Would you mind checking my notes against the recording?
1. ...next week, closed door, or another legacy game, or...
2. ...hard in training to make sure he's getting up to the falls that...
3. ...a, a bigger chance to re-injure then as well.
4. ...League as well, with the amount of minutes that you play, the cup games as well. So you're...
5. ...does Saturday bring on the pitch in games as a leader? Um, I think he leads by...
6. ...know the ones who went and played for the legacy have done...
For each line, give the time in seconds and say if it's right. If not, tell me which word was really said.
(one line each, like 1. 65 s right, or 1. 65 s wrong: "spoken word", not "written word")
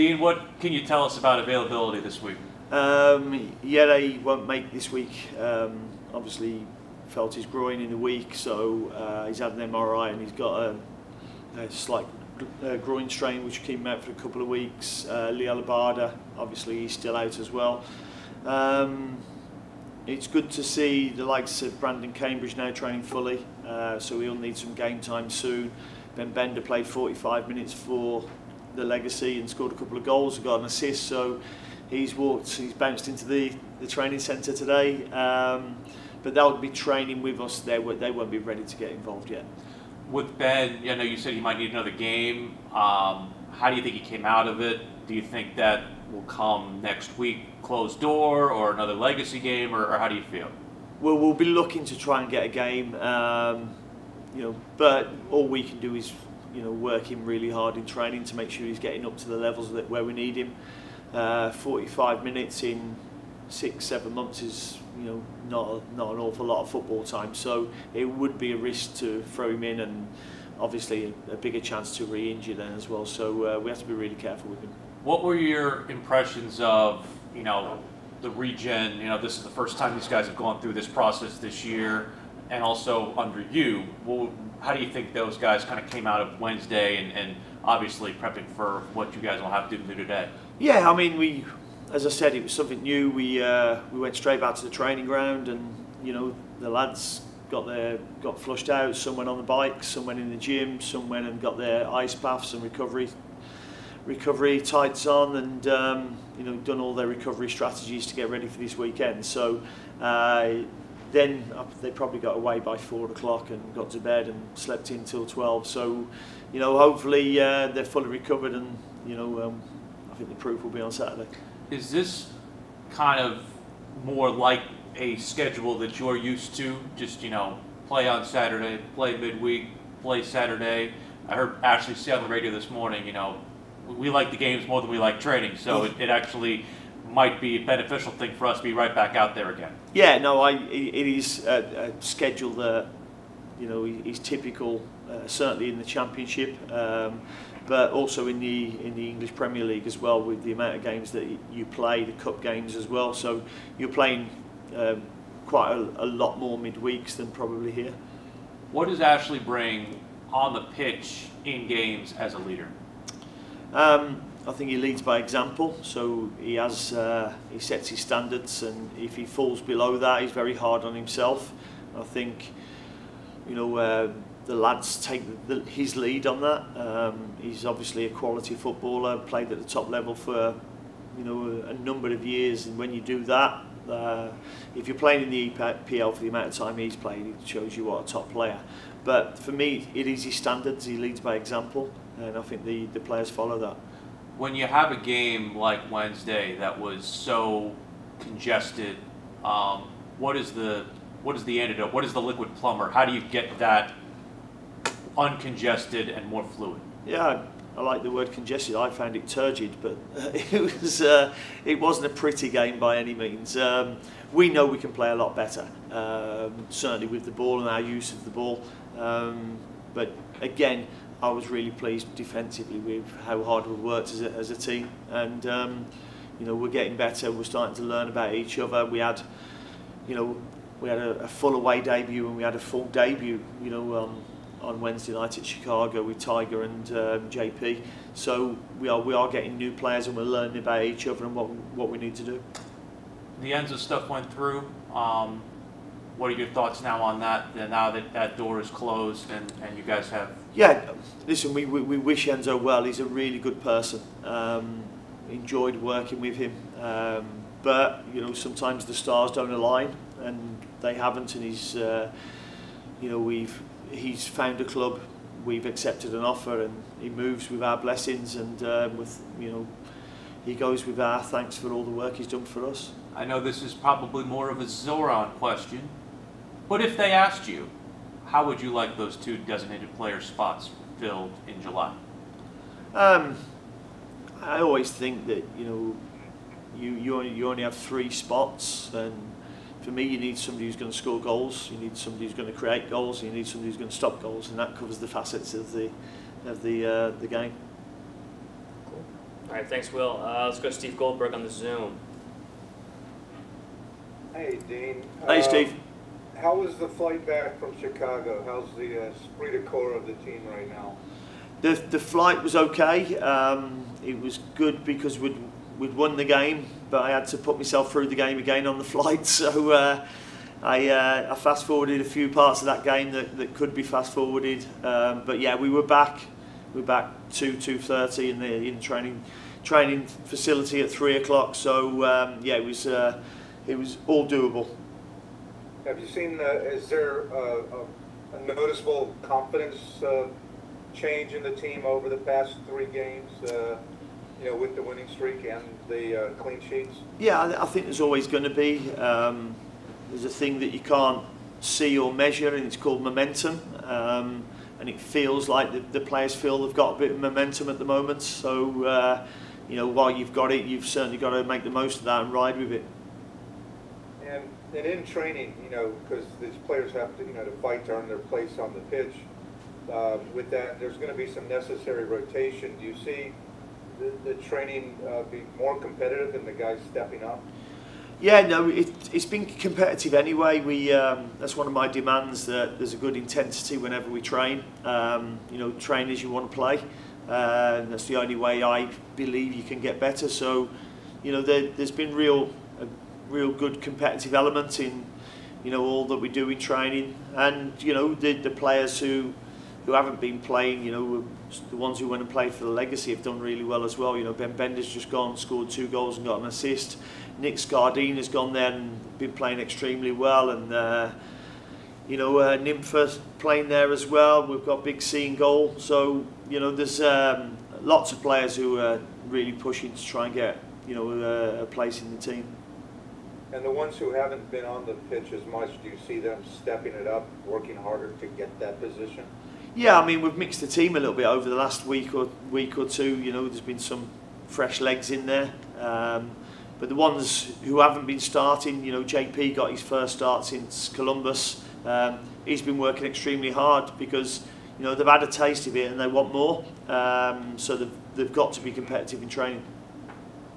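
1. 46 s right
2. 57 s wrong: "levels", not "falls"
3. 71 s right
4. 149 s wrong: "games", not "minutes"
5. 158 s wrong: "Ashley", not "Saturday"
6. 400 s right.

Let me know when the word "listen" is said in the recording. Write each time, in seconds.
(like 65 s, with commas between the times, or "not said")
251 s.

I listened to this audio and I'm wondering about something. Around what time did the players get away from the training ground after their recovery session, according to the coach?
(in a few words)
4 o'clock.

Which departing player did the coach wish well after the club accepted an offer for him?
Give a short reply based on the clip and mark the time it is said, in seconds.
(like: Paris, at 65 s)
Enzo, at 252 s.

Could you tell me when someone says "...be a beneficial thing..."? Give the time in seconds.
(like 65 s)
137 s.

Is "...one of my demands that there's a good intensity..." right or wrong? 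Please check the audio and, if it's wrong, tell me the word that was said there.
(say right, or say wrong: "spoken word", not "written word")
right.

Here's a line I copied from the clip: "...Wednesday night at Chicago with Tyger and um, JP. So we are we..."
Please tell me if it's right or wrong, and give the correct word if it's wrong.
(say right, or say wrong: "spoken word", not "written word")
right.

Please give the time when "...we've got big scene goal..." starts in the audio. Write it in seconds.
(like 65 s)
414 s.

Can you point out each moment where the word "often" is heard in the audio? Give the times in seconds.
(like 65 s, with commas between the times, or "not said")
not said.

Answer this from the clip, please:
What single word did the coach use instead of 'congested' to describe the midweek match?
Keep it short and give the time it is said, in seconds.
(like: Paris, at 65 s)
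turgid, at 209 s.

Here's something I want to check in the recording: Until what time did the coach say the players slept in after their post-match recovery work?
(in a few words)
12.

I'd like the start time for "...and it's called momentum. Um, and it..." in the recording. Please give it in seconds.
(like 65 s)
352 s.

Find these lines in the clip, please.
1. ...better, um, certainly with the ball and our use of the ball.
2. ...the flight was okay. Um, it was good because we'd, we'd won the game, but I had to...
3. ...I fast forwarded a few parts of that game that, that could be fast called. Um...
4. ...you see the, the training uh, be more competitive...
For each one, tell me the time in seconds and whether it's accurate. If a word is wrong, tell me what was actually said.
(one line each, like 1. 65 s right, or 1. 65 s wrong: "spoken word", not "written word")
1. 215 s right
2. 311 s right
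3. 321 s wrong: "forwarded", not "called"
4. 372 s right.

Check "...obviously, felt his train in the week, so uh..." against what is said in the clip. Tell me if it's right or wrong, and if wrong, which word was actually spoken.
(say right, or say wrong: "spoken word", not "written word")
wrong: "groin", not "train".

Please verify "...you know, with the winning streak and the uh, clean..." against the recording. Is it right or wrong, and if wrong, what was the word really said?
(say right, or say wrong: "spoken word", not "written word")
right.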